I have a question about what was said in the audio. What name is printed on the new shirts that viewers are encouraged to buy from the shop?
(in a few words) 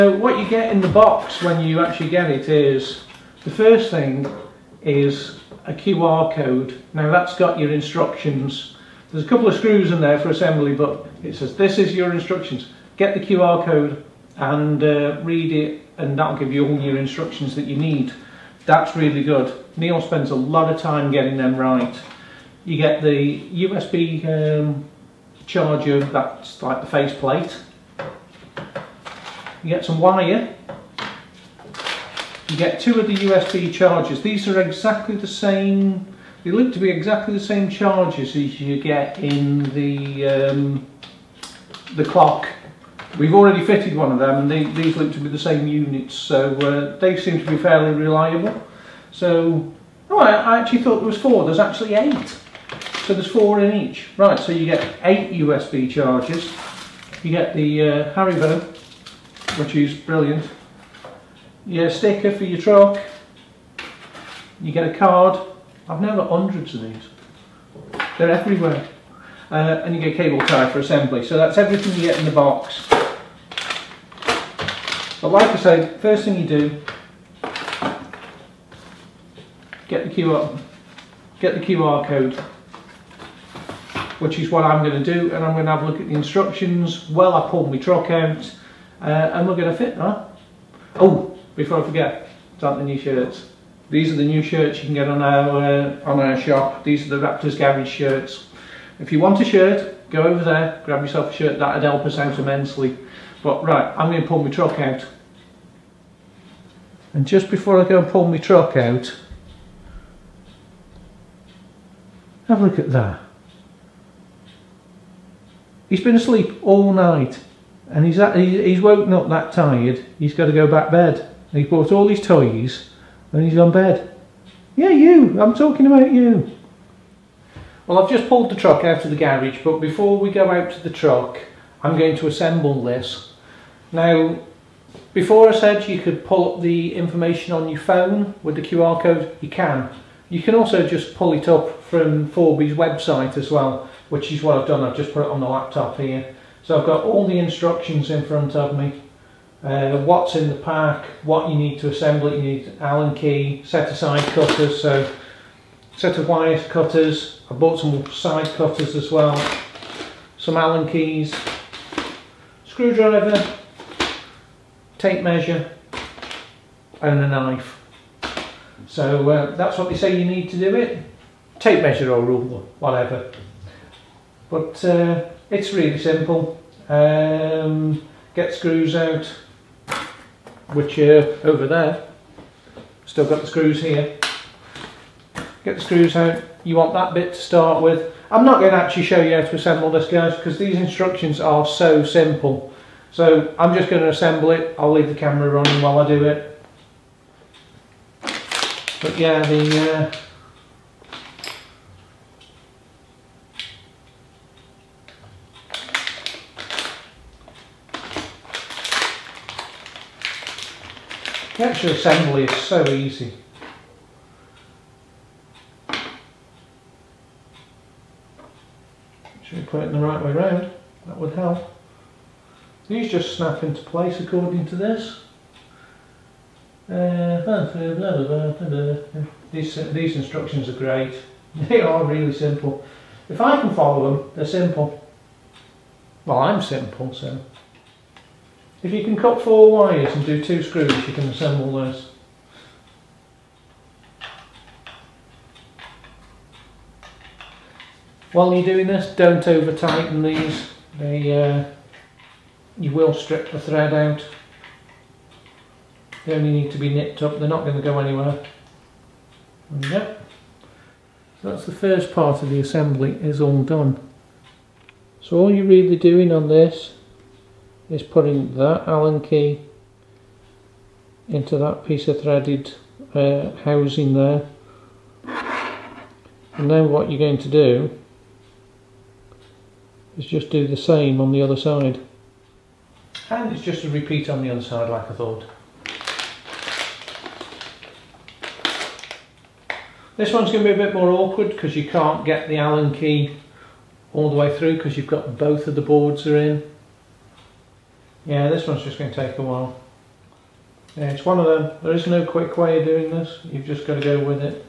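Raptors Garage.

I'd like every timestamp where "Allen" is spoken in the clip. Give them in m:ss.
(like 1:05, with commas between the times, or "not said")
2:32, 2:40, 4:28, 4:52.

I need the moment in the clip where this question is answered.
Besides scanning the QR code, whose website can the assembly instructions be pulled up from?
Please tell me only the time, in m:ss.
2:22.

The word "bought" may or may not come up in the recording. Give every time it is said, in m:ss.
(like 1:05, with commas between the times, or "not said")
2:01, 2:37.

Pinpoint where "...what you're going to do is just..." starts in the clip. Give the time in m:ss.
4:36.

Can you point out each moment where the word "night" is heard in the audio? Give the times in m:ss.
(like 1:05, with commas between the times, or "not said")
1:56.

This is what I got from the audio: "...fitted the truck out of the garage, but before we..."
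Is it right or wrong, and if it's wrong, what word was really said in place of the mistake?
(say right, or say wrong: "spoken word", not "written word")
wrong: "pulled", not "fitted".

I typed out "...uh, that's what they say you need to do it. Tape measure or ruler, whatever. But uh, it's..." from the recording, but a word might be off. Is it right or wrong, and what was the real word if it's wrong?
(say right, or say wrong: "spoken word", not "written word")
right.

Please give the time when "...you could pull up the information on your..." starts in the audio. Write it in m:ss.
2:15.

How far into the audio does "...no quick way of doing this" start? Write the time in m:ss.
5:02.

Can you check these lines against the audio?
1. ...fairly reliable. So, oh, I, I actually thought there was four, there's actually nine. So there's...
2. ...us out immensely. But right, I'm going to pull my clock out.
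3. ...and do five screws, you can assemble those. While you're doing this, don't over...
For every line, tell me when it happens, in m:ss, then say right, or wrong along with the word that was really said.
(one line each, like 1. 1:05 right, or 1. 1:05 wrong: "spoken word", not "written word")
1. 0:47 wrong: "eight", not "nine"
2. 1:42 wrong: "truck", not "clock"
3. 4:00 wrong: "two", not "five".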